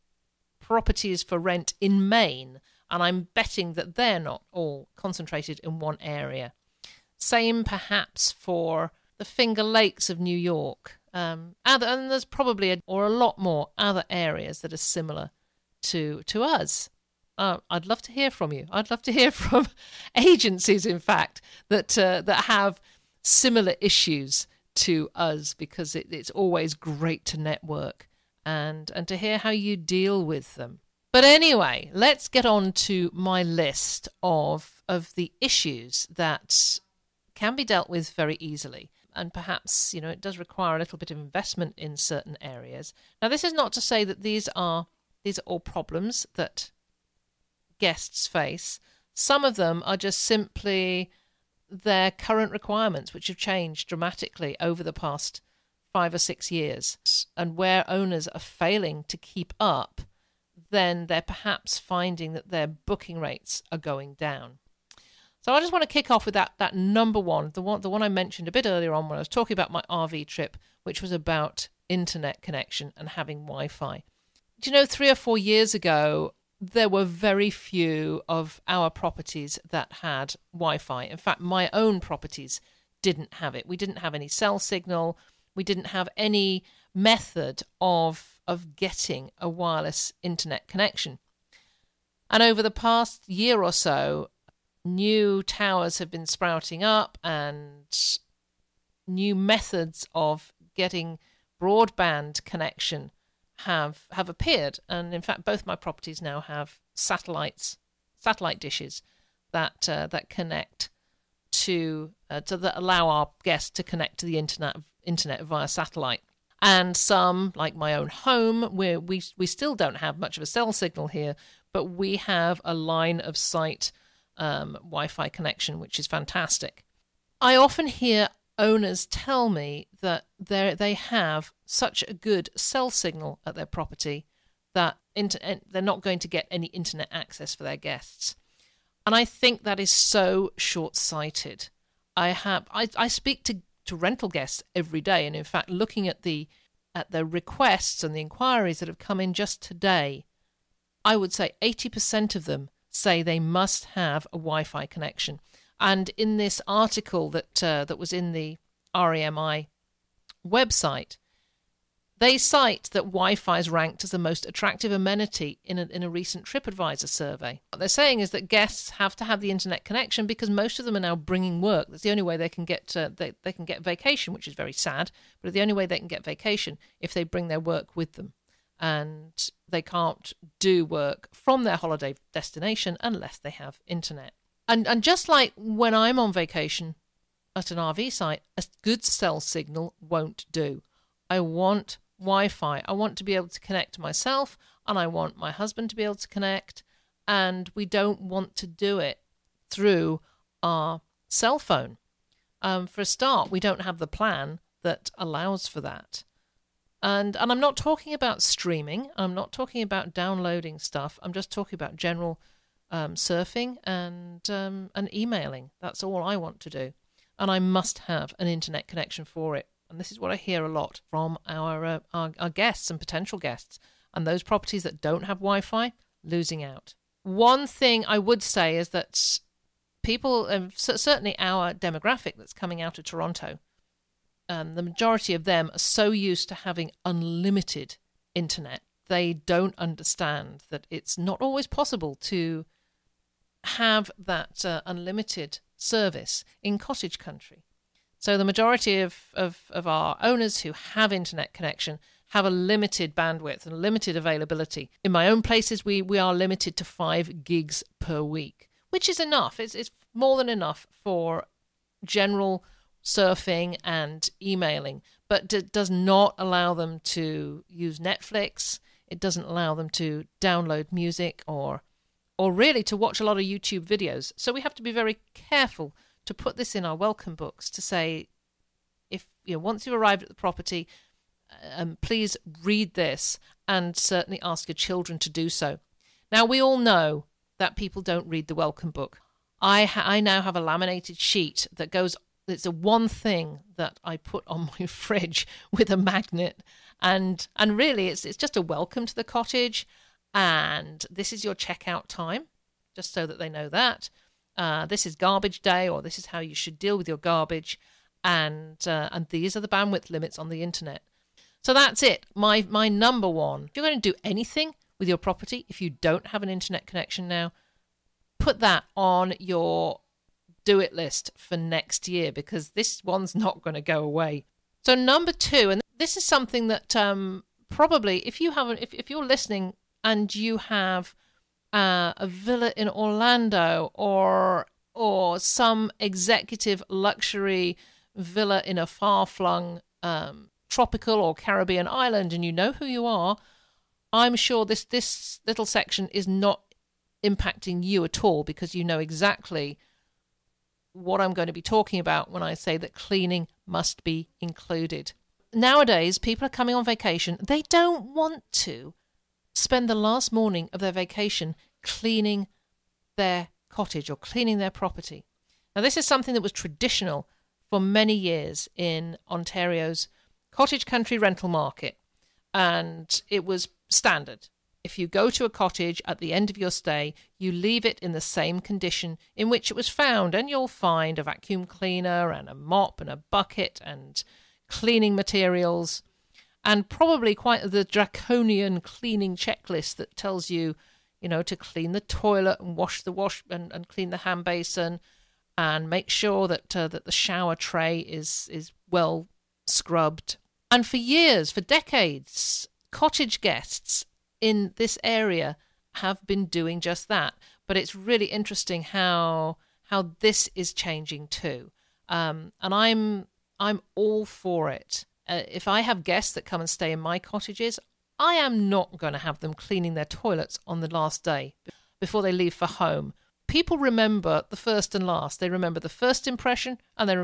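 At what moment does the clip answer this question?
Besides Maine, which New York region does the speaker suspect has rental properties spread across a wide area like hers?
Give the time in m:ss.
0:09.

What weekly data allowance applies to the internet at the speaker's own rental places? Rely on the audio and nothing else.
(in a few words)
5 gigs.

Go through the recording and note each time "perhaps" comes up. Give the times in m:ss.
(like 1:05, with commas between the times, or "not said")
0:07, 0:39, 1:01.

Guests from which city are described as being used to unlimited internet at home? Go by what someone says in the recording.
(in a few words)
Toronto.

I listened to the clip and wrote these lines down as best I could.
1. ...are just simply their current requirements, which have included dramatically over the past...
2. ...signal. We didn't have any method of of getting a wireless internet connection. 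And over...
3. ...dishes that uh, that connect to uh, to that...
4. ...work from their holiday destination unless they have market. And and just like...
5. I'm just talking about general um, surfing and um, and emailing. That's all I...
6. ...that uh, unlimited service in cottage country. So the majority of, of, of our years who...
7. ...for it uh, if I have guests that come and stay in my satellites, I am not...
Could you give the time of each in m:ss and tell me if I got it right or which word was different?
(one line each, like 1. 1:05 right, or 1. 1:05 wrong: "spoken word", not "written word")
1. 0:49 wrong: "changed", not "included"
2. 1:24 right
3. 1:48 right
4. 3:00 wrong: "internet", not "market"
5. 3:31 right
6. 4:04 wrong: "owners", not "years"
7. 6:54 wrong: "cottages", not "satellites".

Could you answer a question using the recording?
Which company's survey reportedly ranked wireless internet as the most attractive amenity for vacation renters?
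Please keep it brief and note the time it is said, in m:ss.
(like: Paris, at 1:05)
TripAdvisor, at 2:46.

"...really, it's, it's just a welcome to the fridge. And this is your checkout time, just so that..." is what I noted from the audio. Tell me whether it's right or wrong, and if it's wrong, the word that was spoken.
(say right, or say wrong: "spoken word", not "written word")
wrong: "cottage", not "fridge".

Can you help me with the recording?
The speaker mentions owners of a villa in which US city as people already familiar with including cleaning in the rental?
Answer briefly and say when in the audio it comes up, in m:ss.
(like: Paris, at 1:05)
Orlando, at 5:32.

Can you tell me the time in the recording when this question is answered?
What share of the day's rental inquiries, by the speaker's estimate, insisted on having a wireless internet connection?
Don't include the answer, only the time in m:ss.
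2:31.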